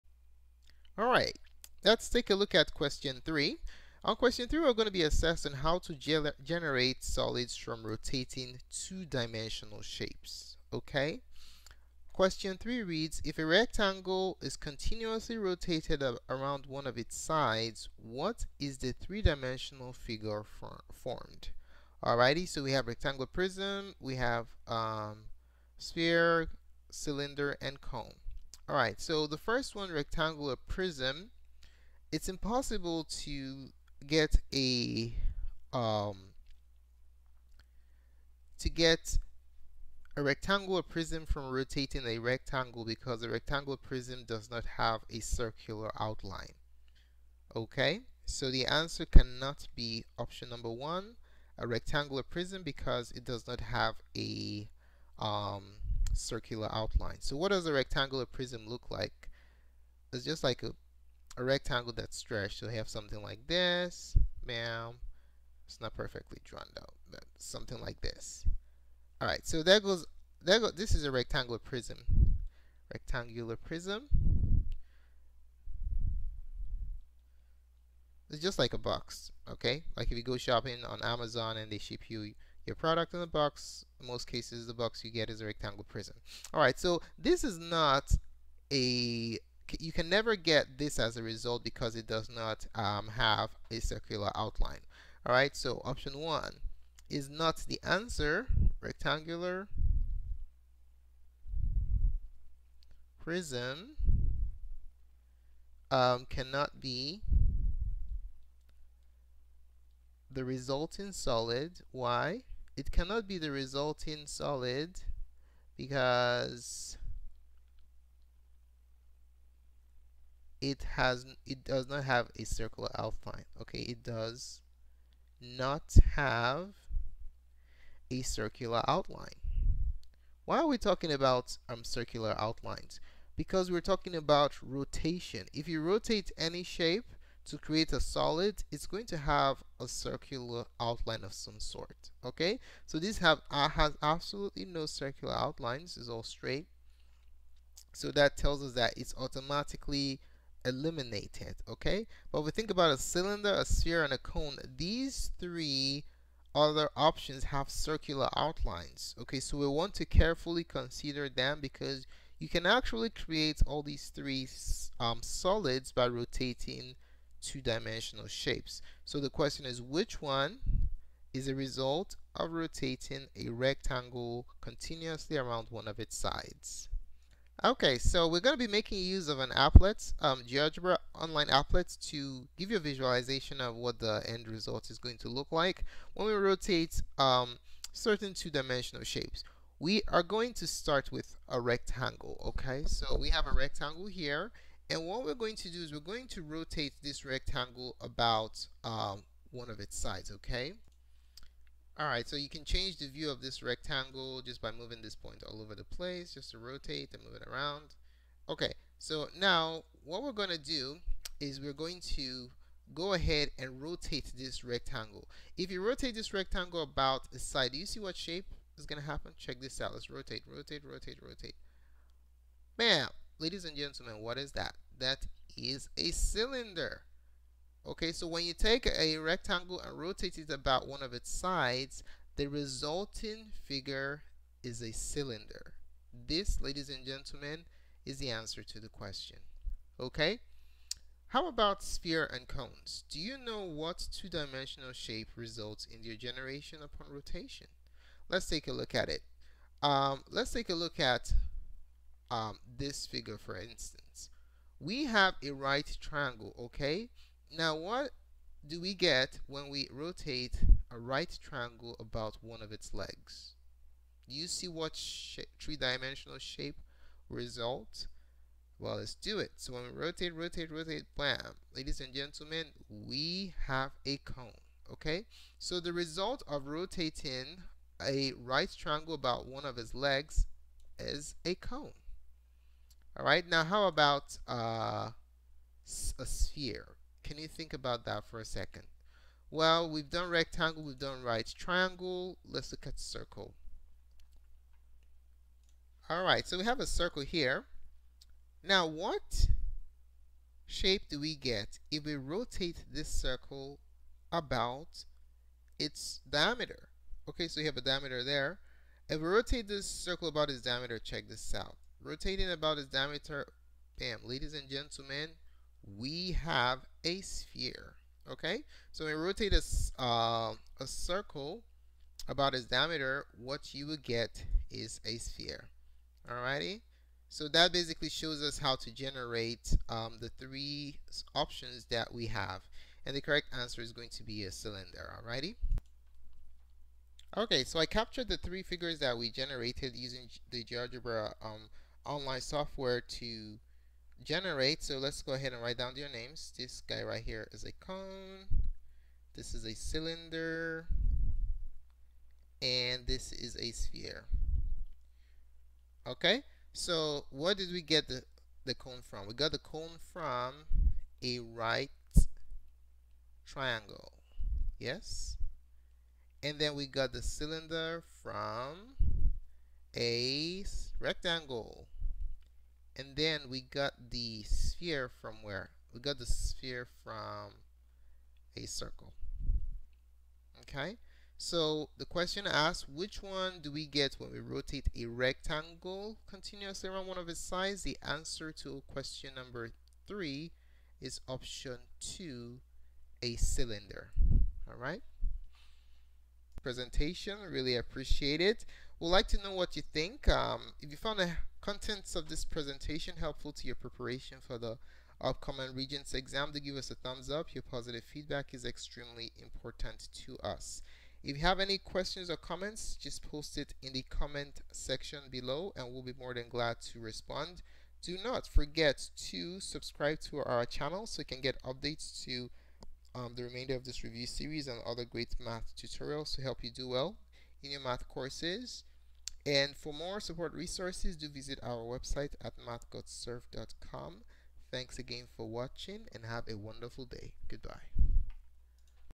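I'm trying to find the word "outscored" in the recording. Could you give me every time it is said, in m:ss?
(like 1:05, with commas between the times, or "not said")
not said.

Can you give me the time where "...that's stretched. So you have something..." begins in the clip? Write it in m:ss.
1:01.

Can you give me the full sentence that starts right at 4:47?
Can you think about that for a second?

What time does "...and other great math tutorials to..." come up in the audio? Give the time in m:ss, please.
7:04.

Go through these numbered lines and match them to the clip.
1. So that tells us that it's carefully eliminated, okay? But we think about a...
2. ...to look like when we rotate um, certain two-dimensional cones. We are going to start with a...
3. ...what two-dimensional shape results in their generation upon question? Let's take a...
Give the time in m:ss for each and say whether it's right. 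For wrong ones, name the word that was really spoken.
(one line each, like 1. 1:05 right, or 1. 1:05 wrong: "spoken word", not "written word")
1. 2:27 wrong: "automatically", not "carefully"
2. 3:05 wrong: "shapes", not "cones"
3. 4:03 wrong: "rotation", not "question".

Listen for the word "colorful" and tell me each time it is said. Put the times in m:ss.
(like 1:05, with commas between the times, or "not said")
not said.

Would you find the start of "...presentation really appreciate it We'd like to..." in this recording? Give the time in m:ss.
6:36.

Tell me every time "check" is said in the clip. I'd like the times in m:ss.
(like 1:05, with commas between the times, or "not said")
3:39, 5:10.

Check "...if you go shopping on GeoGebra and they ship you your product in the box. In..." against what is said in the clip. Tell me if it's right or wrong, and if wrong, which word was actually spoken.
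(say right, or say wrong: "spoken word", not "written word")
wrong: "Amazon", not "GeoGebra".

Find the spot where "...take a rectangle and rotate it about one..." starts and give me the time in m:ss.
3:48.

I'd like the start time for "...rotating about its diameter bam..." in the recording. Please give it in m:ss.
5:12.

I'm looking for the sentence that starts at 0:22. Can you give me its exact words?
Alrighty, so we have rectangular prism, we have um, sphere, cylinder, and cone.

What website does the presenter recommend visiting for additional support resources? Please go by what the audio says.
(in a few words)
mathgotserved.com.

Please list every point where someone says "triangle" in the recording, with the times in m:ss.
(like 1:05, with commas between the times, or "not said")
4:16, 4:21, 4:38, 4:51, 6:03.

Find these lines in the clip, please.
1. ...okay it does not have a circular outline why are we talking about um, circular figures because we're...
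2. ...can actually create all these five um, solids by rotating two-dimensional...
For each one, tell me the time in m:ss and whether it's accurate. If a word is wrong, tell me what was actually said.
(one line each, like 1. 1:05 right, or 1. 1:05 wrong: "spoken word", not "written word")
1. 2:03 wrong: "outlines", not "figures"
2. 2:42 wrong: "three", not "five".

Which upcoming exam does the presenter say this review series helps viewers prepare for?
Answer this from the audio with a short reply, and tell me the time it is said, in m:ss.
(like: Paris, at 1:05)
Regents, at 6:45.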